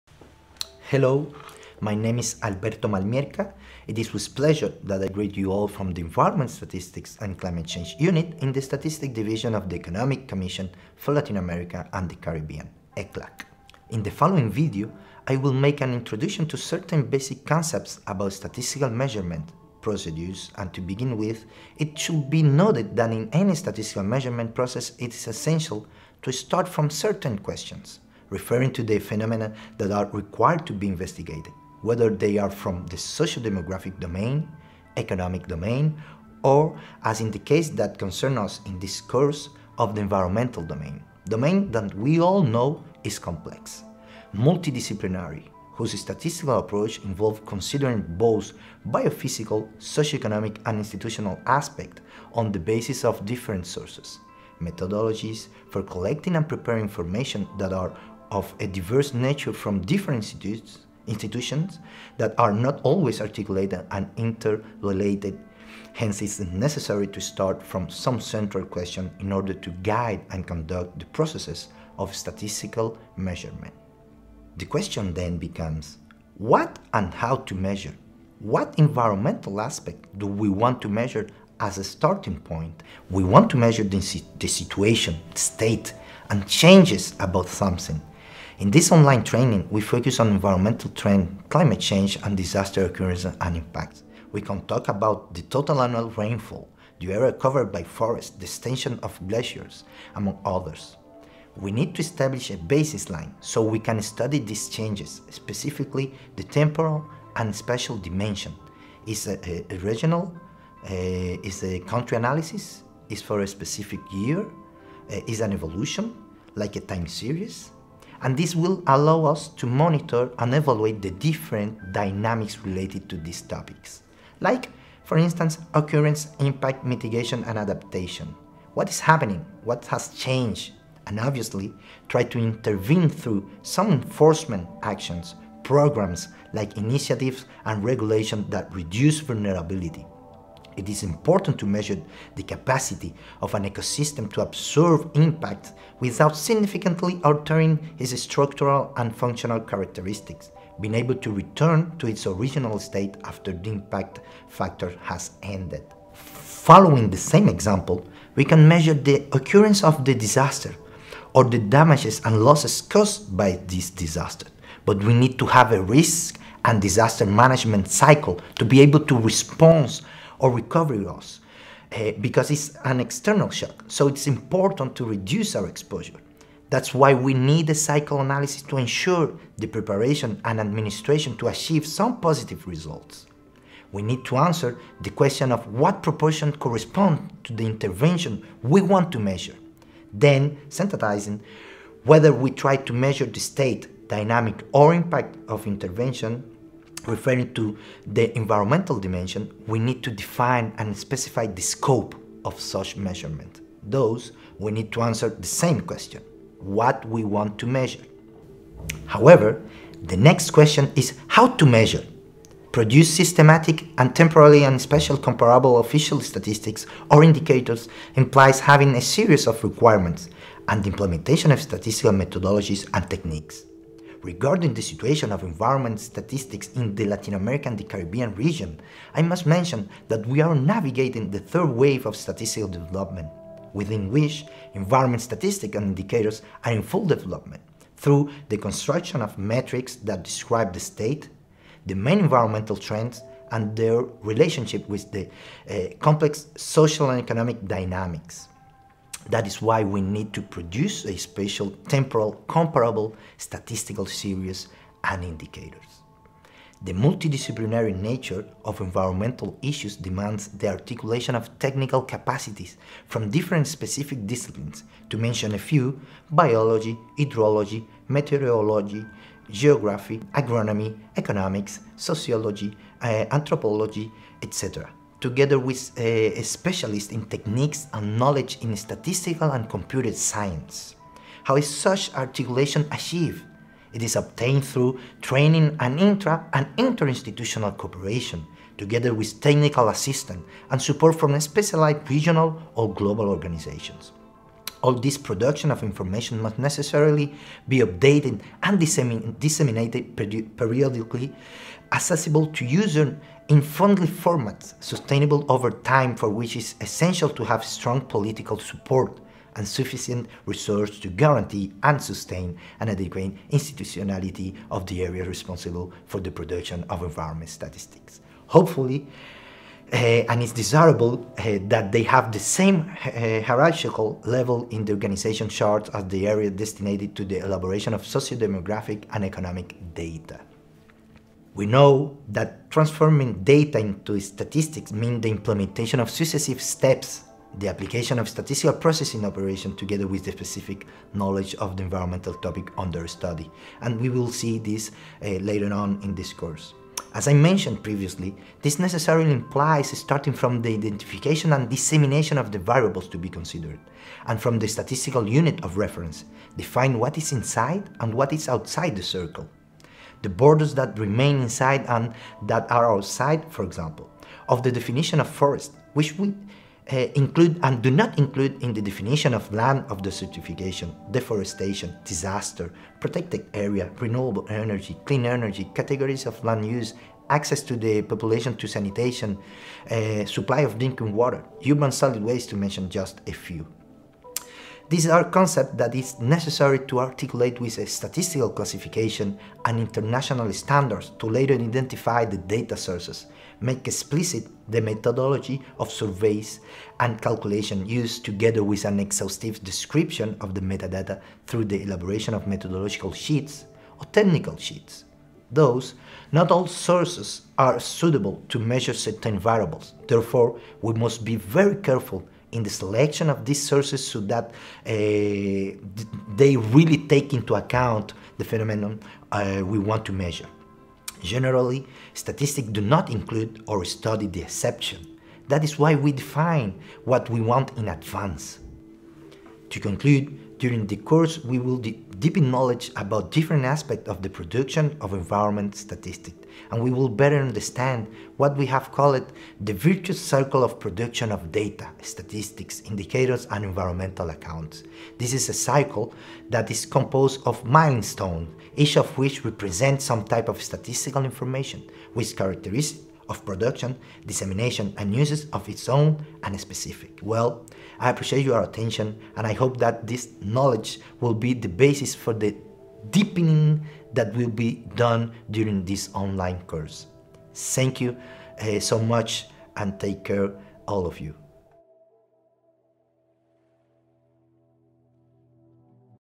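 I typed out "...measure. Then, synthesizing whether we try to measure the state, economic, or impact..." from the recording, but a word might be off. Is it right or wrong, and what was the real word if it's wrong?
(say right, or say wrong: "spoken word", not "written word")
wrong: "dynamic", not "economic".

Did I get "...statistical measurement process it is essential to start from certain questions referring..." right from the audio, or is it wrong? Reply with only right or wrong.
right.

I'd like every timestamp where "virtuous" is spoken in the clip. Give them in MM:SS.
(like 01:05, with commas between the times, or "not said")
07:19.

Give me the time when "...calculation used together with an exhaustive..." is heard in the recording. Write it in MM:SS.
06:37.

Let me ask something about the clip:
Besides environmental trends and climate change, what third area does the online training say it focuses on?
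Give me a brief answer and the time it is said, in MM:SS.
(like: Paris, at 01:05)
disaster occurrence and impacts, at 01:32.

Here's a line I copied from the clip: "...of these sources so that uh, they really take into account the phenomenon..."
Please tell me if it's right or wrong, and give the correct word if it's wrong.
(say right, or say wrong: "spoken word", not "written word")
right.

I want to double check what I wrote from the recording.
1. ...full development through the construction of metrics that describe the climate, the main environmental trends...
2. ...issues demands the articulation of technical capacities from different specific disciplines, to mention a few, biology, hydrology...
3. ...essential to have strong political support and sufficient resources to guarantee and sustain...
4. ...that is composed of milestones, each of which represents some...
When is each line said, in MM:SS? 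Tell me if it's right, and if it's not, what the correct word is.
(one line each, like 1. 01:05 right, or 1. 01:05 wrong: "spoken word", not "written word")
1. 03:56 wrong: "state", not "climate"
2. 04:19 right
3. 05:06 right
4. 07:26 right.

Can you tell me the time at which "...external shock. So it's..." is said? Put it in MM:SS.
02:52.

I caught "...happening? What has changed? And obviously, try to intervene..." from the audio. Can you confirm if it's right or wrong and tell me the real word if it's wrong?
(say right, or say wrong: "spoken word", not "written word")
right.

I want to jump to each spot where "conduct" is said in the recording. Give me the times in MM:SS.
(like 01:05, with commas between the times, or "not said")
01:10.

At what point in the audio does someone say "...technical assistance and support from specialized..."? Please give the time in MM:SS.
04:49.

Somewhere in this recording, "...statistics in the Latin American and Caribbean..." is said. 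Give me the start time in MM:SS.
03:45.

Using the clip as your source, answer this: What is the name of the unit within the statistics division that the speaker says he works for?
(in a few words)
Environment Statistics and Climate Change Unit.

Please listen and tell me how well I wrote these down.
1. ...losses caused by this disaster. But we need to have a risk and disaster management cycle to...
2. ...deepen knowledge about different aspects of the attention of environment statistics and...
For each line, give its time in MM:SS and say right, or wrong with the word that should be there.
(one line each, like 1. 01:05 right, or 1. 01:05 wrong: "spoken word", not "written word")
1. 02:42 right
2. 07:11 wrong: "production", not "attention".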